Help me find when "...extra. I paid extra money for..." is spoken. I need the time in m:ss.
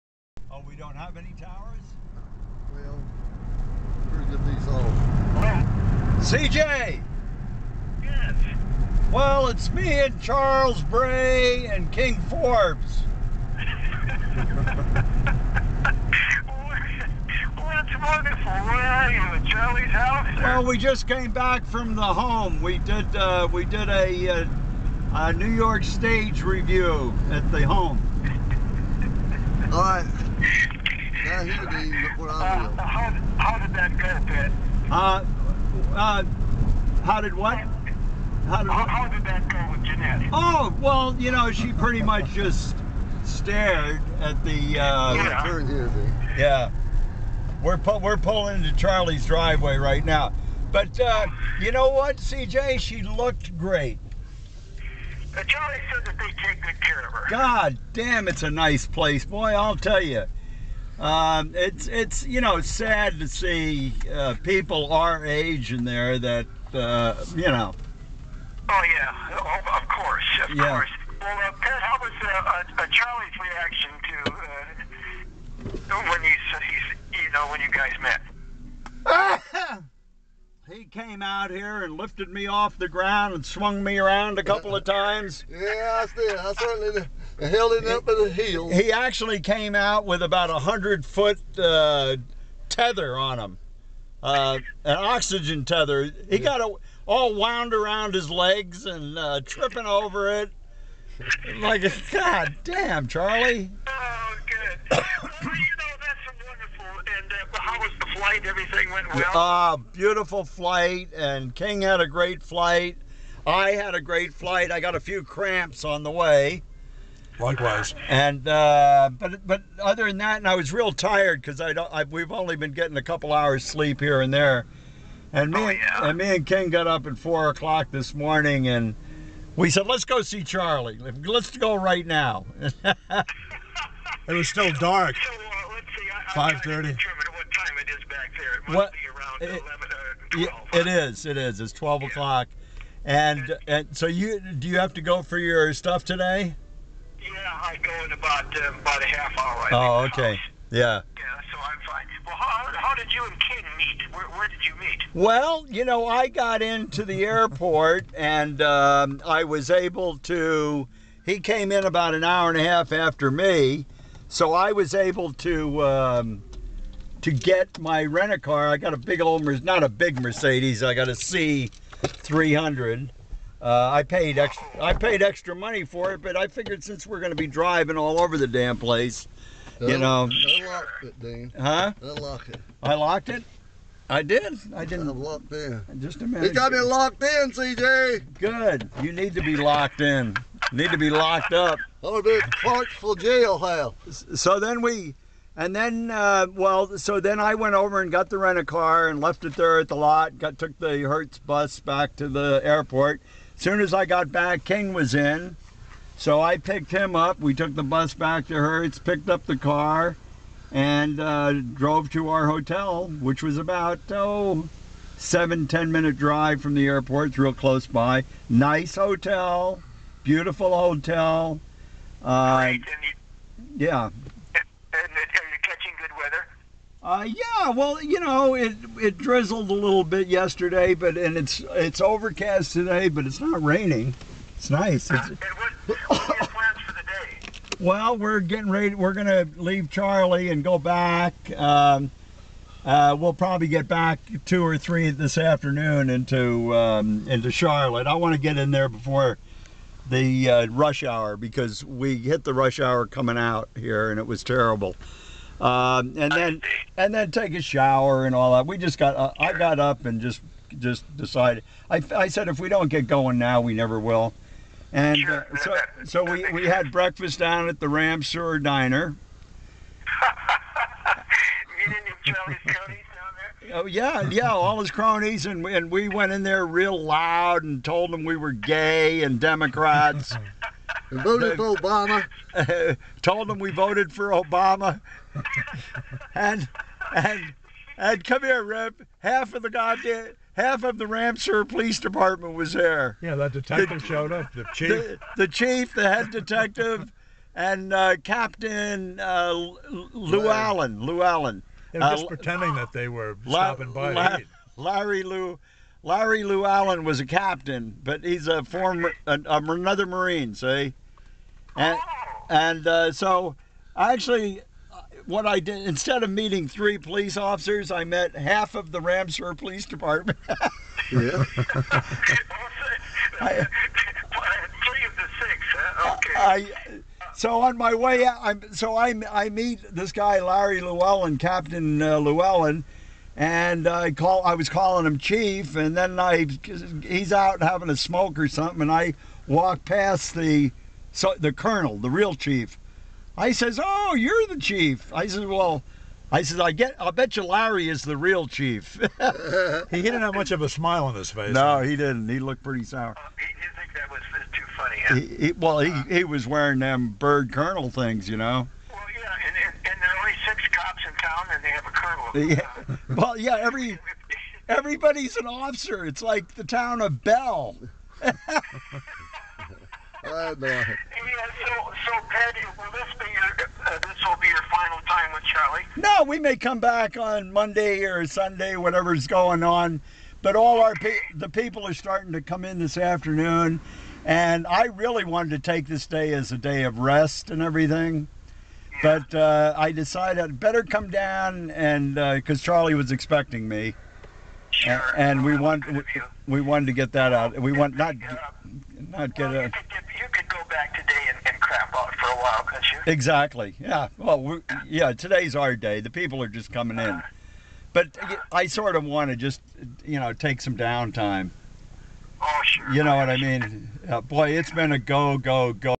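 2:54.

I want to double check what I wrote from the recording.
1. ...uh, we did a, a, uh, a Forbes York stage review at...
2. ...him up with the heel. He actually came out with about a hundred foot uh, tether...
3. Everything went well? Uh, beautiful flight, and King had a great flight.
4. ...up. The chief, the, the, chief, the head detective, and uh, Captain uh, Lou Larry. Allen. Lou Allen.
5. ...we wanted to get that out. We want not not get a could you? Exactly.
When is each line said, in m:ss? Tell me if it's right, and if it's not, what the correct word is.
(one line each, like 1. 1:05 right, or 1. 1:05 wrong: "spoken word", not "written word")
1. 0:23 wrong: "New", not "Forbes"
2. 1:27 right
3. 1:48 right
4. 4:54 right
5. 6:36 right.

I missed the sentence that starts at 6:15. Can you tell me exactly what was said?
No, we may come back on Monday or Sunday, whatever's going on.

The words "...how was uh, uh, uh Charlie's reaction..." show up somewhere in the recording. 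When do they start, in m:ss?
1:11.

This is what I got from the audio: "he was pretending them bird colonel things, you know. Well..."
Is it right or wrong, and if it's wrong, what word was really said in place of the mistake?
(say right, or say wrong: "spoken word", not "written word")
wrong: "wearing", not "pretending".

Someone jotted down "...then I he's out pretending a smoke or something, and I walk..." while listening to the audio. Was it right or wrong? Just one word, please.
wrong.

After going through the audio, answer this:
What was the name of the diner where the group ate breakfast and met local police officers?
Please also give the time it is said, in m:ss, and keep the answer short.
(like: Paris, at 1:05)
Ramseur Diner, at 4:27.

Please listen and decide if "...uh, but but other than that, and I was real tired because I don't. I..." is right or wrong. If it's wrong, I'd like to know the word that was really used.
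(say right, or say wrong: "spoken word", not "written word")
right.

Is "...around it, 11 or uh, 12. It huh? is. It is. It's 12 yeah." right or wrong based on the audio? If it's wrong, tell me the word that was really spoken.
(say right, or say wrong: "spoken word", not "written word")
right.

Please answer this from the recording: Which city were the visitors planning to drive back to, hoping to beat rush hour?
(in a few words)
Charlotte.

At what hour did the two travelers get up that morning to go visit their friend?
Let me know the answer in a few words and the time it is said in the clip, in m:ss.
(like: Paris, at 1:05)
4 o'clock, at 2:07.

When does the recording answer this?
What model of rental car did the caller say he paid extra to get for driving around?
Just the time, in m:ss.
2:51.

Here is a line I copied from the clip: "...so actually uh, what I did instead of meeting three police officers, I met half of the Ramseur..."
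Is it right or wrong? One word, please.
right.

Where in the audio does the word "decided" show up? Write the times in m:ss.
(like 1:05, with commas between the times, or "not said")
4:21, 6:29.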